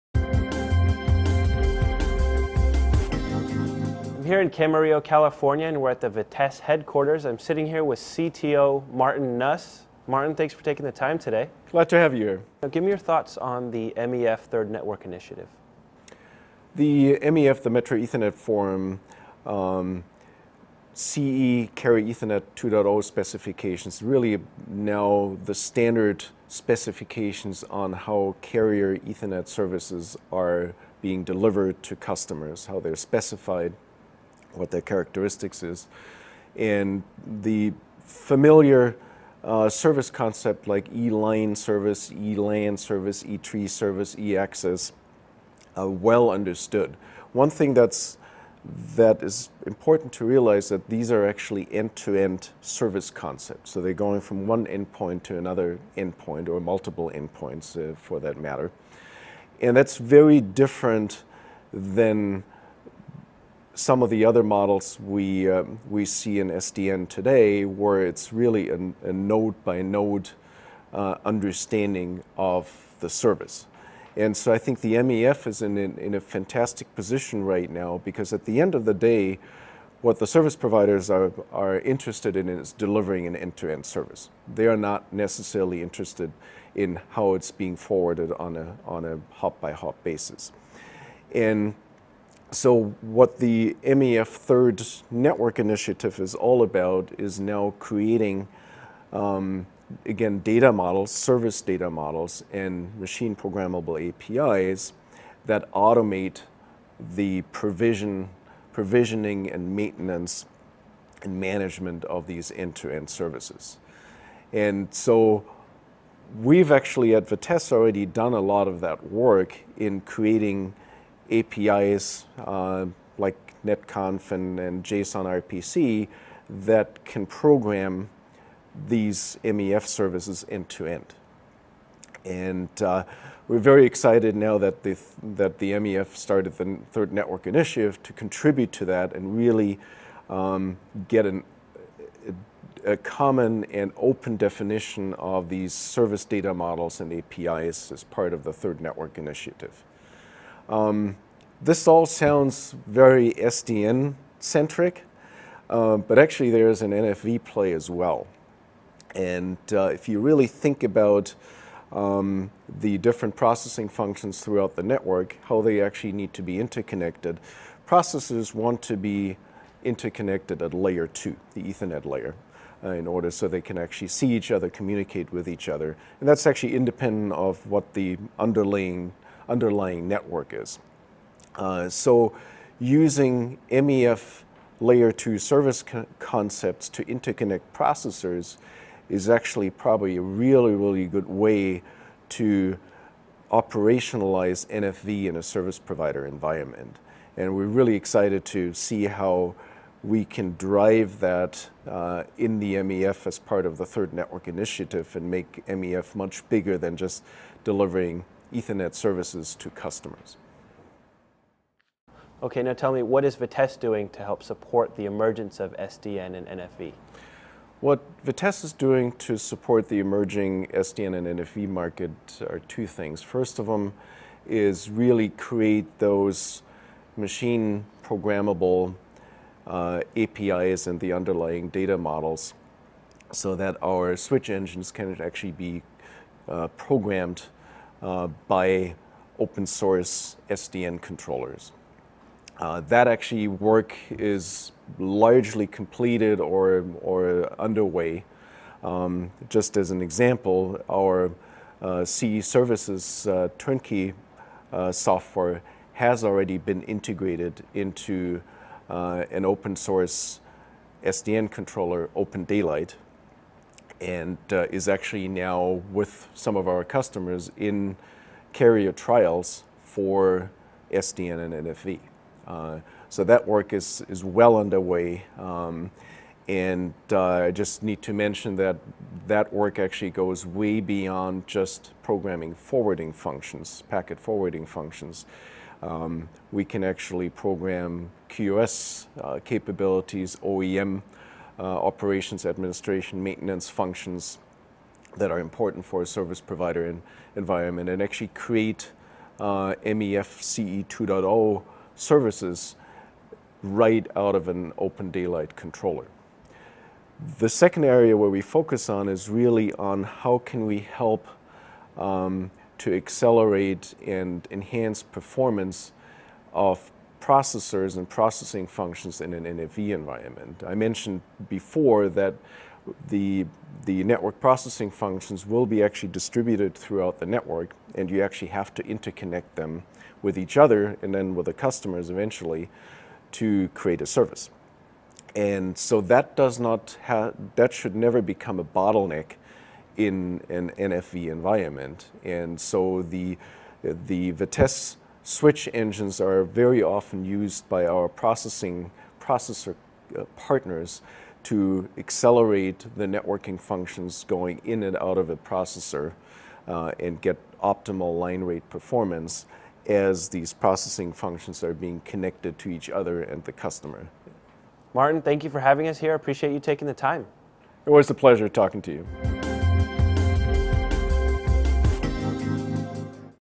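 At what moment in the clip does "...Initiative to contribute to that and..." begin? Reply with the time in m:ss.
2:17.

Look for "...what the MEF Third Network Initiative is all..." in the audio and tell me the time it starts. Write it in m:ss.
1:32.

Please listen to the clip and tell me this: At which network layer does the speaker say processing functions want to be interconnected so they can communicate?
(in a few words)
Layer two.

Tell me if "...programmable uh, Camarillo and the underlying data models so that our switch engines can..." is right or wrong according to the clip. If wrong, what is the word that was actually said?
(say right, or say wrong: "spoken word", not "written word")
wrong: "APIs", not "Camarillo".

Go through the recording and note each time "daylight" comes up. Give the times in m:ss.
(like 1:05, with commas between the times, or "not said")
4:22, 5:05.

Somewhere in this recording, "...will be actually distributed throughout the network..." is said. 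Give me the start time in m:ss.
5:25.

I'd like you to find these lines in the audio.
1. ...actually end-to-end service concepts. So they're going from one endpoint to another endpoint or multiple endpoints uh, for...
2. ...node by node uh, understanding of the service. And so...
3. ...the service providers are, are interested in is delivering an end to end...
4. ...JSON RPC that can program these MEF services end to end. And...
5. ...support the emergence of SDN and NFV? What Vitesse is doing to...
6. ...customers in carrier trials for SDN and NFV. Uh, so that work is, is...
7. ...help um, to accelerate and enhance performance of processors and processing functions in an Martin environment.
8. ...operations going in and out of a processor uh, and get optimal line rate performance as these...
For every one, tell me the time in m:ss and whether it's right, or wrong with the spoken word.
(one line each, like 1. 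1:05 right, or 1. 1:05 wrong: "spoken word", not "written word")
1. 0:51 right
2. 1:09 right
3. 1:20 right
4. 2:04 right
5. 3:34 right
6. 4:26 right
7. 5:10 wrong: "NFV", not "Martin"
8. 5:53 wrong: "functions", not "operations".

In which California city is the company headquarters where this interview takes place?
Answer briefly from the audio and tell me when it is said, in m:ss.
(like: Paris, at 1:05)
Camarillo, at 0:04.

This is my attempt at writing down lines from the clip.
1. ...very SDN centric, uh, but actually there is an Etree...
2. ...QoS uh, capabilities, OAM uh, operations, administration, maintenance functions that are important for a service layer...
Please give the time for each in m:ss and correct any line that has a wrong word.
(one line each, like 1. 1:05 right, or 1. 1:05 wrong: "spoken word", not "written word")
1. 2:32 wrong: "NFV", not "Etree"
2. 4:48 wrong: "provider", not "layer".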